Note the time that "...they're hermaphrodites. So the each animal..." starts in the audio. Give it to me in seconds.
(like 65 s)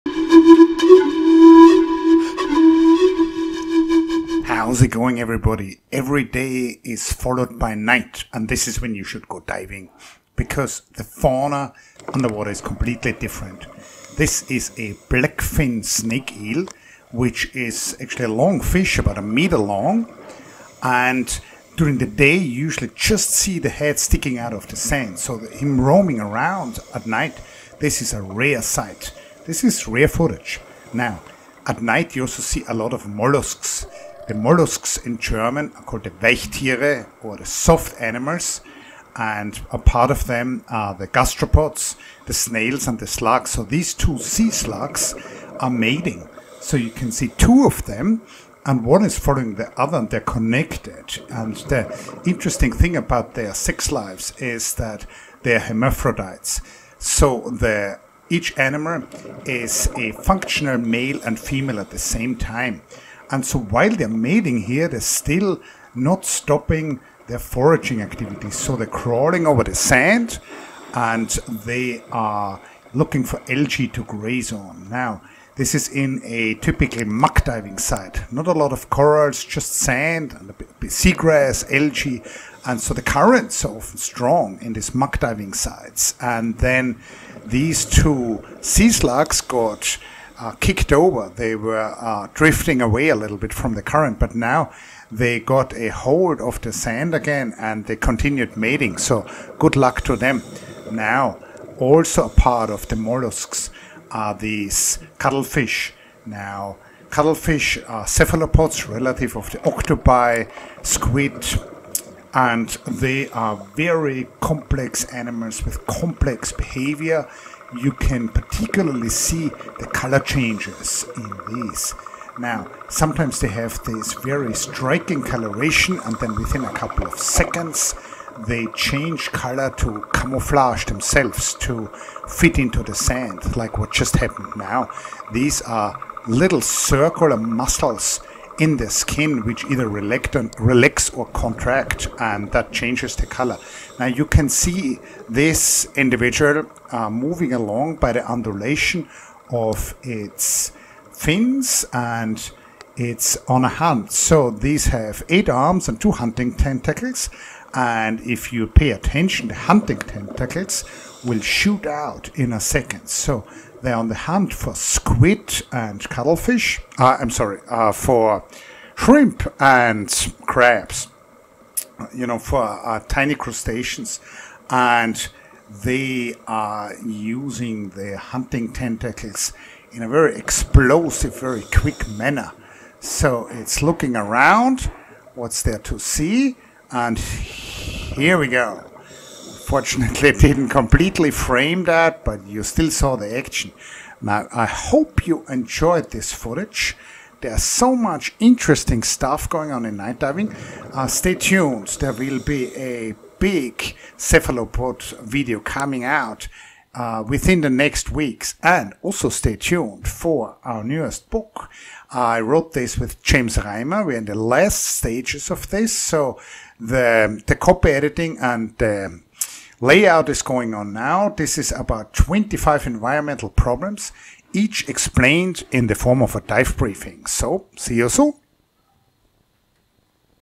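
55 s.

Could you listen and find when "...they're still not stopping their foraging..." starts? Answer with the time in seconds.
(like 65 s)
64 s.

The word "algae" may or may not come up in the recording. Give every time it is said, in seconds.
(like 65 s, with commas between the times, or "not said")
73 s, 81 s.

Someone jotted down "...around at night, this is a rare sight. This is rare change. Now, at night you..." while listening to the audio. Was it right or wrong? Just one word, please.
wrong.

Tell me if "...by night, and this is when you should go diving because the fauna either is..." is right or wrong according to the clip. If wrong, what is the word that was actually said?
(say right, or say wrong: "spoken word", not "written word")
wrong: "underwater", not "either".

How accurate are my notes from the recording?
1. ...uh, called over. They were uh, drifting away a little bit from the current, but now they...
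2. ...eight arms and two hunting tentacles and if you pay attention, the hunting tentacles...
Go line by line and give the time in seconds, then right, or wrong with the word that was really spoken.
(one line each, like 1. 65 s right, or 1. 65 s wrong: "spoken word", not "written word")
1. 90 s wrong: "kicked", not "called"
2. 155 s right.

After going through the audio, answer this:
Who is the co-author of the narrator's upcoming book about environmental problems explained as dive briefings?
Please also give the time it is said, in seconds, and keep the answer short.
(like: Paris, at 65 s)
James Reimer, at 213 s.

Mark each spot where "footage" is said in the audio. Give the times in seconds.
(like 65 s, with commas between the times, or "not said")
30 s, 196 s.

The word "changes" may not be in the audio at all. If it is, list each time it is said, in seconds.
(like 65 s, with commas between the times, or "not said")
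120 s, 128 s, 142 s.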